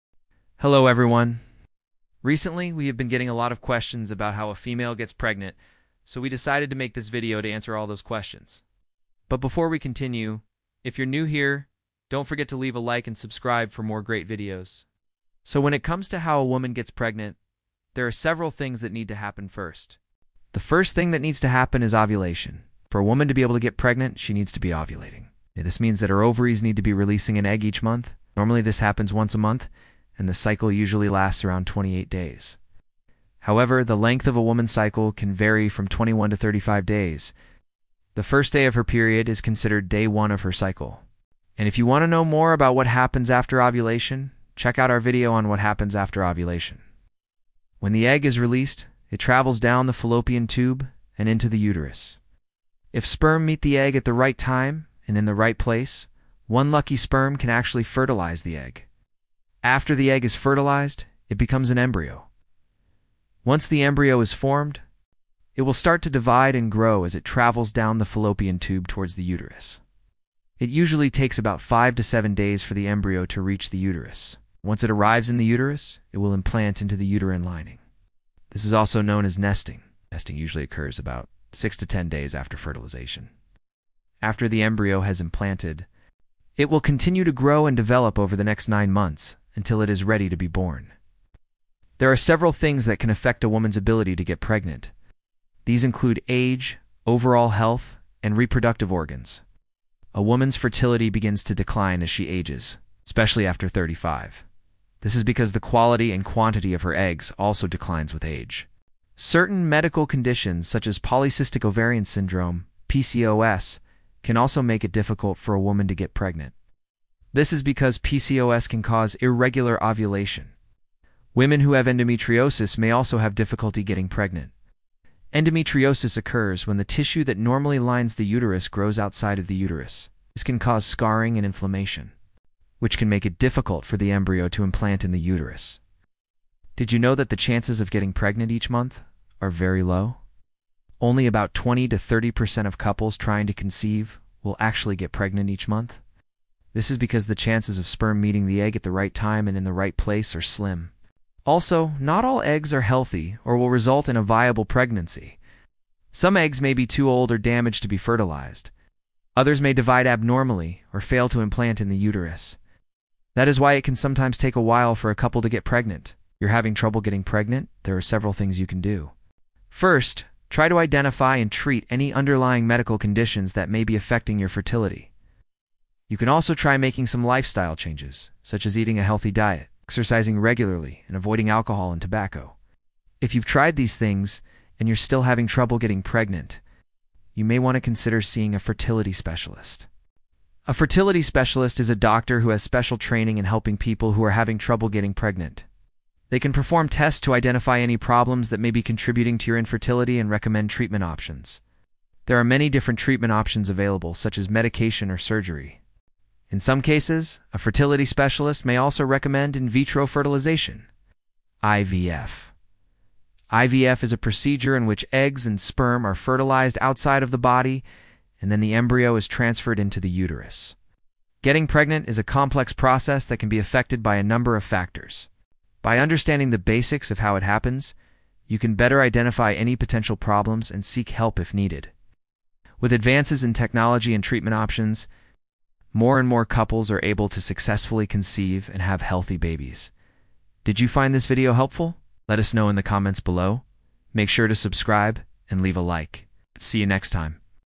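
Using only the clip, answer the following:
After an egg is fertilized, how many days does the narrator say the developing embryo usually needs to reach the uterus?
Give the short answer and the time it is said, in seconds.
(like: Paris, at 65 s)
5 to 7 days, at 71 s.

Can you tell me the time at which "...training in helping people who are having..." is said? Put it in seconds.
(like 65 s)
192 s.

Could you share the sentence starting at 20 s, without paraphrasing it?
The first thing that needs to happen is ovulation.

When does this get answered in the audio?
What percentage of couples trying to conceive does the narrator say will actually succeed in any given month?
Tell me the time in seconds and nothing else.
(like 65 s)
141 s.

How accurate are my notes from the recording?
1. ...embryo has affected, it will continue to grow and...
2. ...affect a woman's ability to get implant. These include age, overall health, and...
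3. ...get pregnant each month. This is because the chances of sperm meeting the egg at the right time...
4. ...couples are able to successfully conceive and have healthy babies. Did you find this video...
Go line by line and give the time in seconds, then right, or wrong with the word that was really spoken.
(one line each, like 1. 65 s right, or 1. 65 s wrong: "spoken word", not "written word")
1. 84 s wrong: "implanted", not "affected"
2. 93 s wrong: "pregnant", not "implant"
3. 144 s right
4. 236 s right.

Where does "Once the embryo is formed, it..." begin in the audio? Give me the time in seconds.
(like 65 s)
63 s.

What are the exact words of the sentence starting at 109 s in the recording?
Certain medical conditions such as polycystic ovarian syndrome, PCOS, can also make it difficult for a woman to get pregnant.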